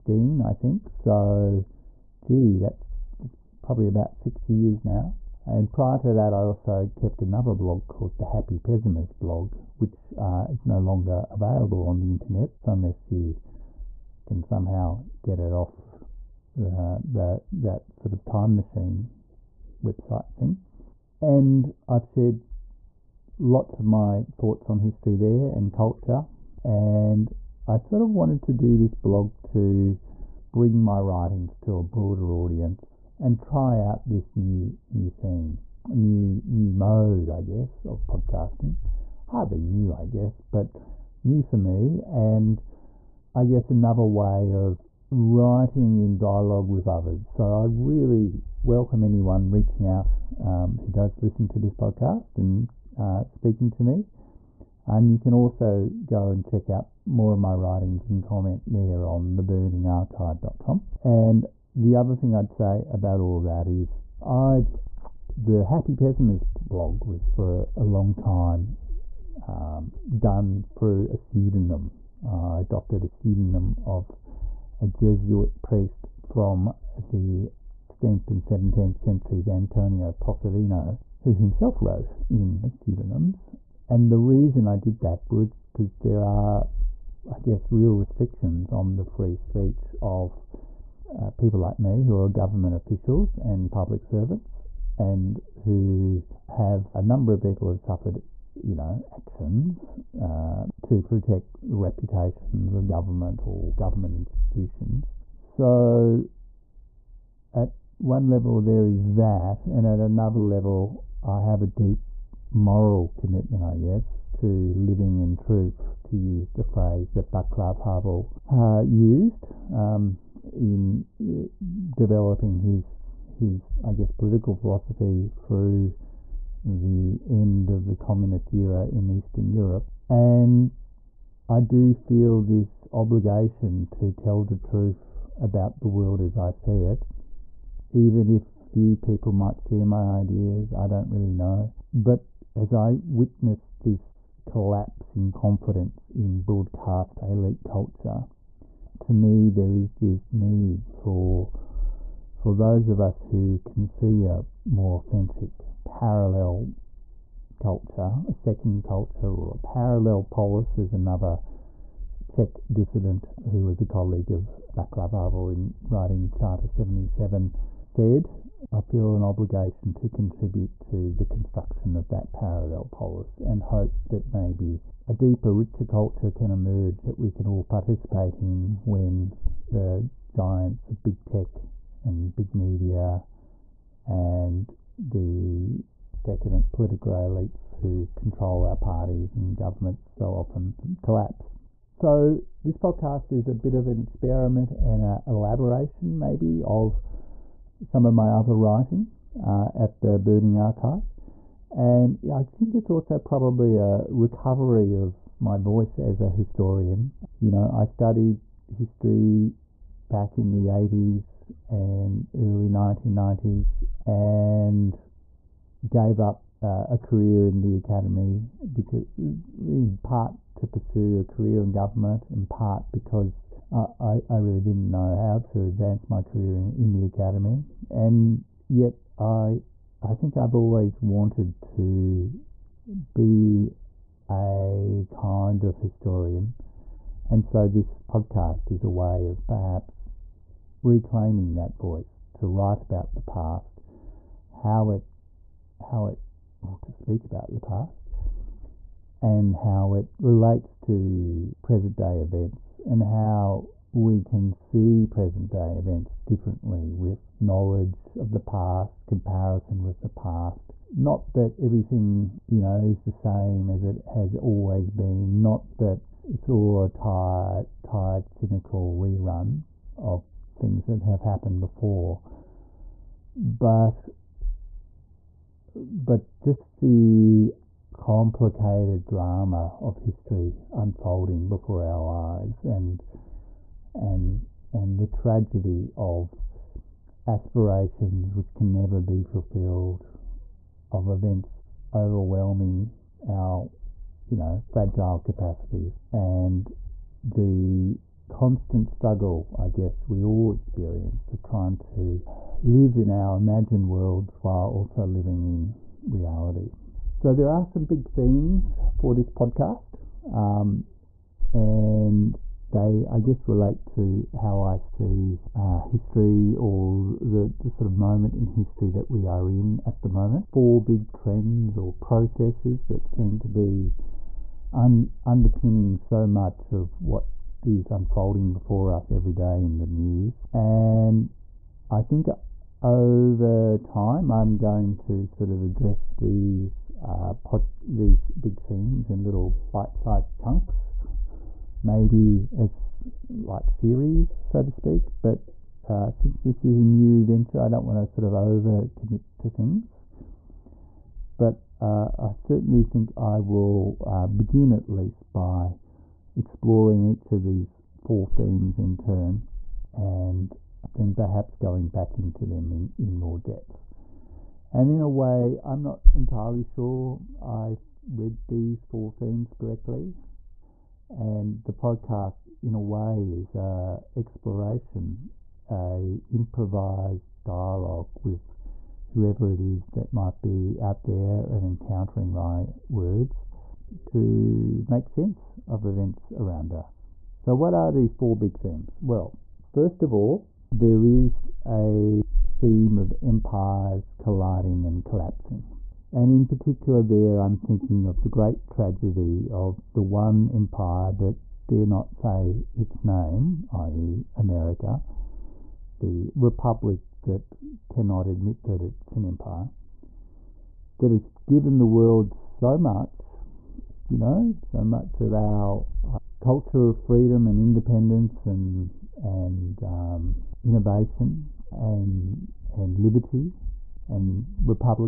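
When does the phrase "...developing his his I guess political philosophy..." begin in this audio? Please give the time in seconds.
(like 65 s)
121 s.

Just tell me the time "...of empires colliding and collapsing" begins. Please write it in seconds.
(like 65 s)
392 s.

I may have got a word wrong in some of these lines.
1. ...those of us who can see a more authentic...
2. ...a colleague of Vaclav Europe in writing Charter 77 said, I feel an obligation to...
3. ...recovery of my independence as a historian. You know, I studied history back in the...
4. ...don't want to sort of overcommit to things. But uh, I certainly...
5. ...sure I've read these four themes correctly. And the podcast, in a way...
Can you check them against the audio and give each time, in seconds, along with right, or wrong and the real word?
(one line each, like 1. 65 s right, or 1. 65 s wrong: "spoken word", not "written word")
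1. 152 s right
2. 163 s wrong: "Havel", not "Europe"
3. 204 s wrong: "voice", not "independence"
4. 347 s right
5. 366 s right.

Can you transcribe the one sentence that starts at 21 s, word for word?
And I've shared lots of my thoughts on history there and culture.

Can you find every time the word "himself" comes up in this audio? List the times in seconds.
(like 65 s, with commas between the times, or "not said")
81 s.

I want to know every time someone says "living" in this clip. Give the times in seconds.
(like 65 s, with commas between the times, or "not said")
114 s, 305 s.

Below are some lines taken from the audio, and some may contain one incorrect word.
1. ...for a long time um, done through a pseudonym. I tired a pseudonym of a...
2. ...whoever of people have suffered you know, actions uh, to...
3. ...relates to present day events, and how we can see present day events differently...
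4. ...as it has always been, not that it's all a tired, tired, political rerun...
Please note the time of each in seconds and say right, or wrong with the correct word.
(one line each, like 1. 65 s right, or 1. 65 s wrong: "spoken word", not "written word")
1. 67 s wrong: "adopted", not "tired"
2. 97 s wrong: "number", not "whoever"
3. 250 s right
4. 263 s wrong: "cynical", not "political".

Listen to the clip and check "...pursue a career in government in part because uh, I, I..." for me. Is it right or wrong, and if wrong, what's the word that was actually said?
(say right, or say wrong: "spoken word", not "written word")
right.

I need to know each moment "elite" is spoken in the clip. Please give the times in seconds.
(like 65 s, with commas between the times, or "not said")
147 s, 187 s.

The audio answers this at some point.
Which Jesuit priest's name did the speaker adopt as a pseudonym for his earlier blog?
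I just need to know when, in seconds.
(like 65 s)
79 s.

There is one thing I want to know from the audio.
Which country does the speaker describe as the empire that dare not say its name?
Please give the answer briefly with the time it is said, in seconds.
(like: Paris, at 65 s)
America, at 404 s.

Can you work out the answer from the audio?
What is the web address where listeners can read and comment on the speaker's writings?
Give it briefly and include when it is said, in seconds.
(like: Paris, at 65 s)
theburningarchive.com, at 59 s.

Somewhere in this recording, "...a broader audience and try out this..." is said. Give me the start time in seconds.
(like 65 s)
31 s.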